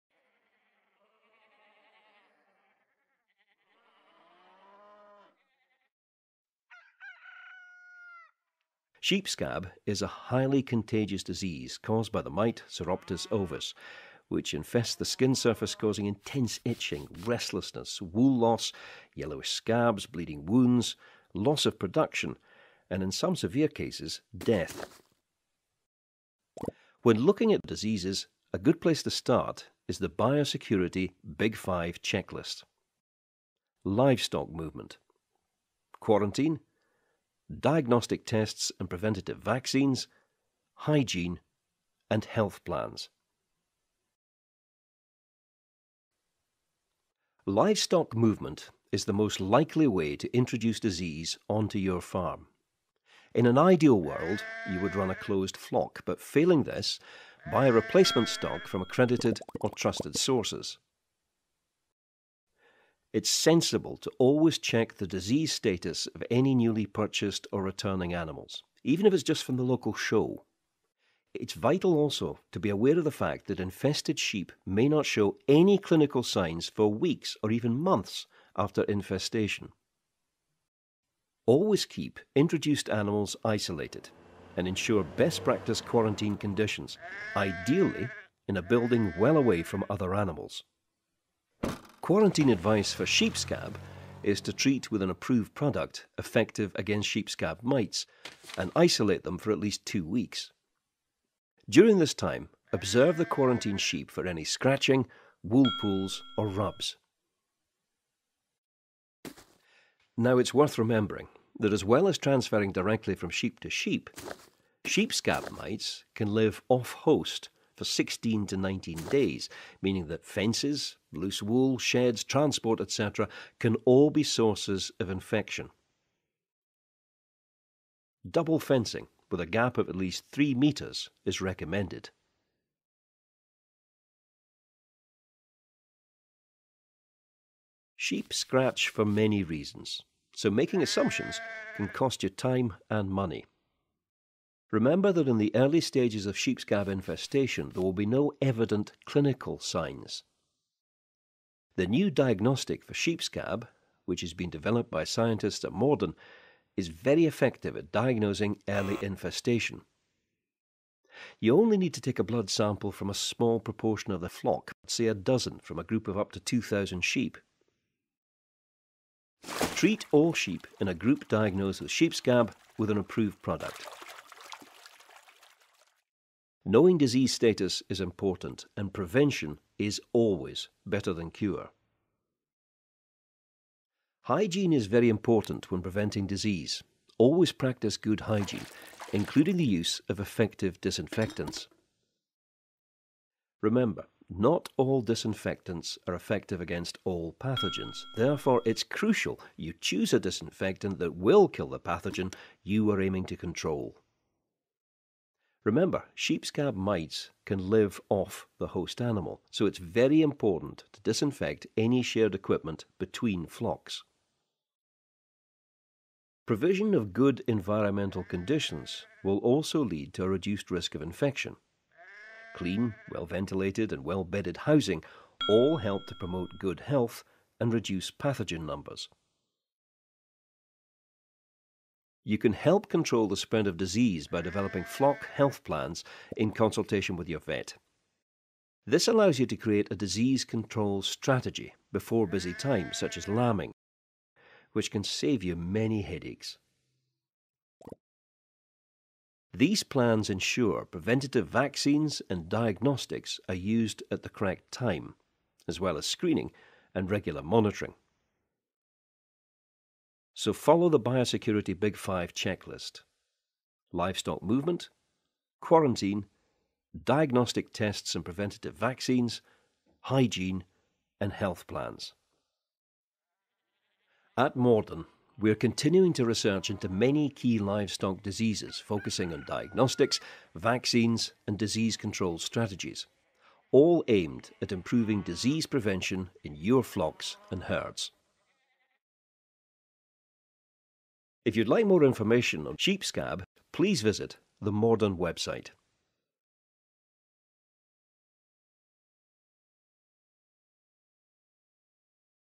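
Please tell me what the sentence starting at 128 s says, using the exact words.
Double fencing with a gap of at least 3 metres is recommended.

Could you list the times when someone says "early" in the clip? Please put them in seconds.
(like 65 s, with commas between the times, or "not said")
145 s, 158 s.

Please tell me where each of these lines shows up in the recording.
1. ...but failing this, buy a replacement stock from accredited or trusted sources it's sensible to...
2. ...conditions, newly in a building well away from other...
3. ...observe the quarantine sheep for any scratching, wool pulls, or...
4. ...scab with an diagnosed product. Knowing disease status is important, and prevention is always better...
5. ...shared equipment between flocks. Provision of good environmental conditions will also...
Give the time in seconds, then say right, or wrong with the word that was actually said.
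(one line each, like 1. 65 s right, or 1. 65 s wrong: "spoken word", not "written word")
1. 56 s right
2. 86 s wrong: "ideally", not "newly"
3. 102 s right
4. 172 s wrong: "approved", not "diagnosed"
5. 212 s right.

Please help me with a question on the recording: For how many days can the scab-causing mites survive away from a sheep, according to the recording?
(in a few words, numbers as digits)
16 to 19 days.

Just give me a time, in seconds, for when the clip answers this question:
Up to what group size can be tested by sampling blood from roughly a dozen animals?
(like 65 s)
166 s.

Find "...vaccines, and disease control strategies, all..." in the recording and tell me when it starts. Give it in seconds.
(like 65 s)
280 s.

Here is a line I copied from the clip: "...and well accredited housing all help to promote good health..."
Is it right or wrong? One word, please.
wrong.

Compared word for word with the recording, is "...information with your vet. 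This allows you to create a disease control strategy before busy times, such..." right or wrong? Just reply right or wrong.
wrong.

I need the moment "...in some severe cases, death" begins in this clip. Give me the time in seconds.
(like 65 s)
23 s.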